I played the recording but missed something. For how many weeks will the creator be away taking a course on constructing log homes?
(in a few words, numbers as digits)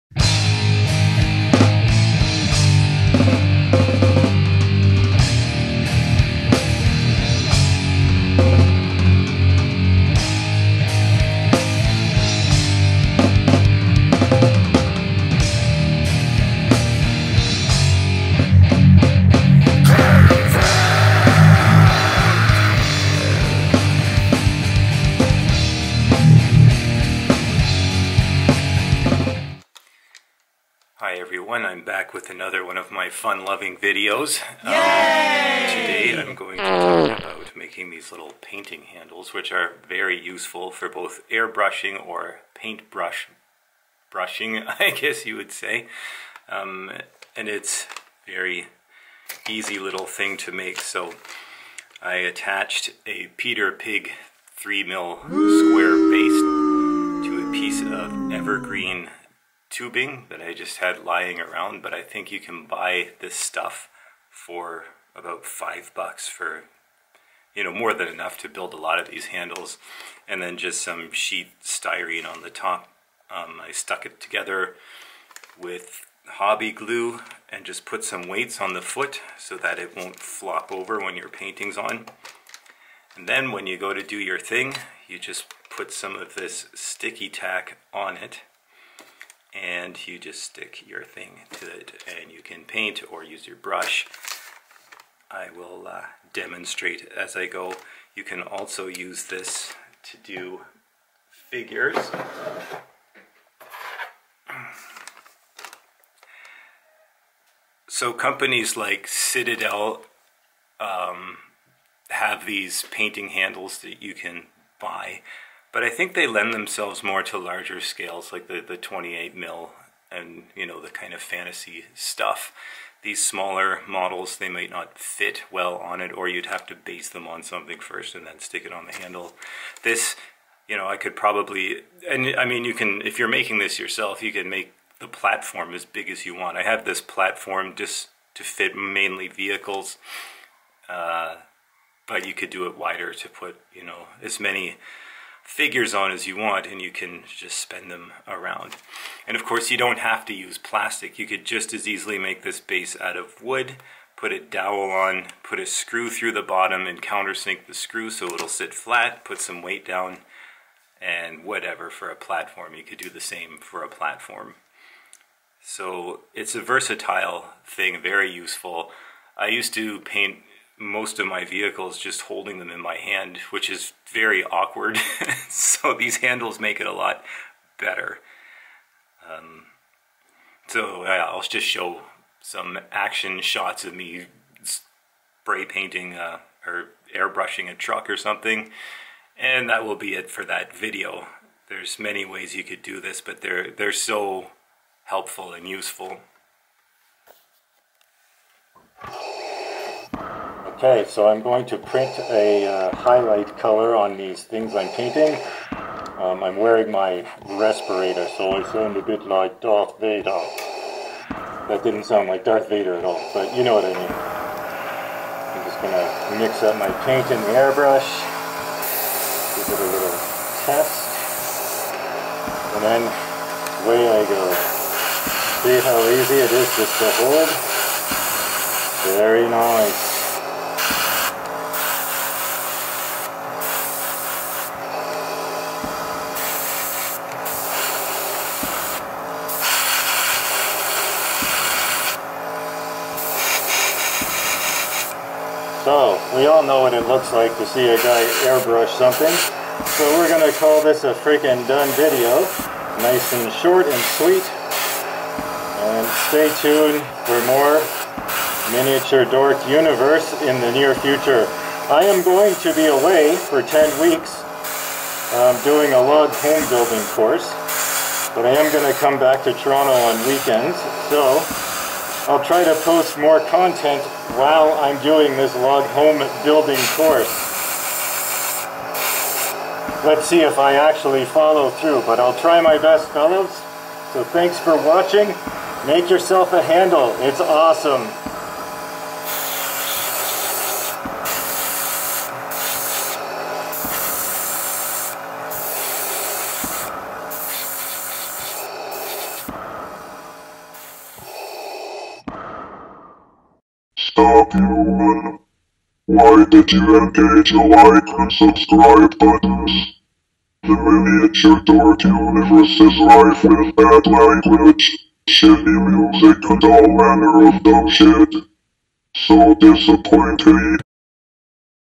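10.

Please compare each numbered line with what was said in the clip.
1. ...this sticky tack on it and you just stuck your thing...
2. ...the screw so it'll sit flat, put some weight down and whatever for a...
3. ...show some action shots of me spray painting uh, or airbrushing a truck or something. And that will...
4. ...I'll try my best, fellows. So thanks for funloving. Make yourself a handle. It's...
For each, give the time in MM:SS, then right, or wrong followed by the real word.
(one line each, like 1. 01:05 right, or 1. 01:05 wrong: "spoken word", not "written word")
1. 01:26 wrong: "stick", not "stuck"
2. 02:37 right
3. 03:01 right
4. 04:42 wrong: "watching", not "funloving".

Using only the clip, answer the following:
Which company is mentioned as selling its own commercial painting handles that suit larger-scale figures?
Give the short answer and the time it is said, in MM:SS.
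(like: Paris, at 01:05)
Citadel, at 01:49.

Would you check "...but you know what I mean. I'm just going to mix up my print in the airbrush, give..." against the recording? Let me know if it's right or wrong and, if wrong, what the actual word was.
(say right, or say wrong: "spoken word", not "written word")
wrong: "paint", not "print".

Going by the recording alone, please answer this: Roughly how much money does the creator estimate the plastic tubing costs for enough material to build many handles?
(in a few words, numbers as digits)
5 dollars.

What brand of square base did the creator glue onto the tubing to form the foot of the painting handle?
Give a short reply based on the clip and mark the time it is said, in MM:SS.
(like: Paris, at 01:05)
Peter Pig, at 00:53.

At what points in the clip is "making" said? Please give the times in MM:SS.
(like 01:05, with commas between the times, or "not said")
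00:37, 02:13.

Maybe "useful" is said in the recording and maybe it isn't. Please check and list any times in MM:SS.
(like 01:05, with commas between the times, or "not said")
00:40, 02:48, 03:15.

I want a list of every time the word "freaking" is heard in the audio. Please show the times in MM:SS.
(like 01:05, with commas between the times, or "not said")
04:11.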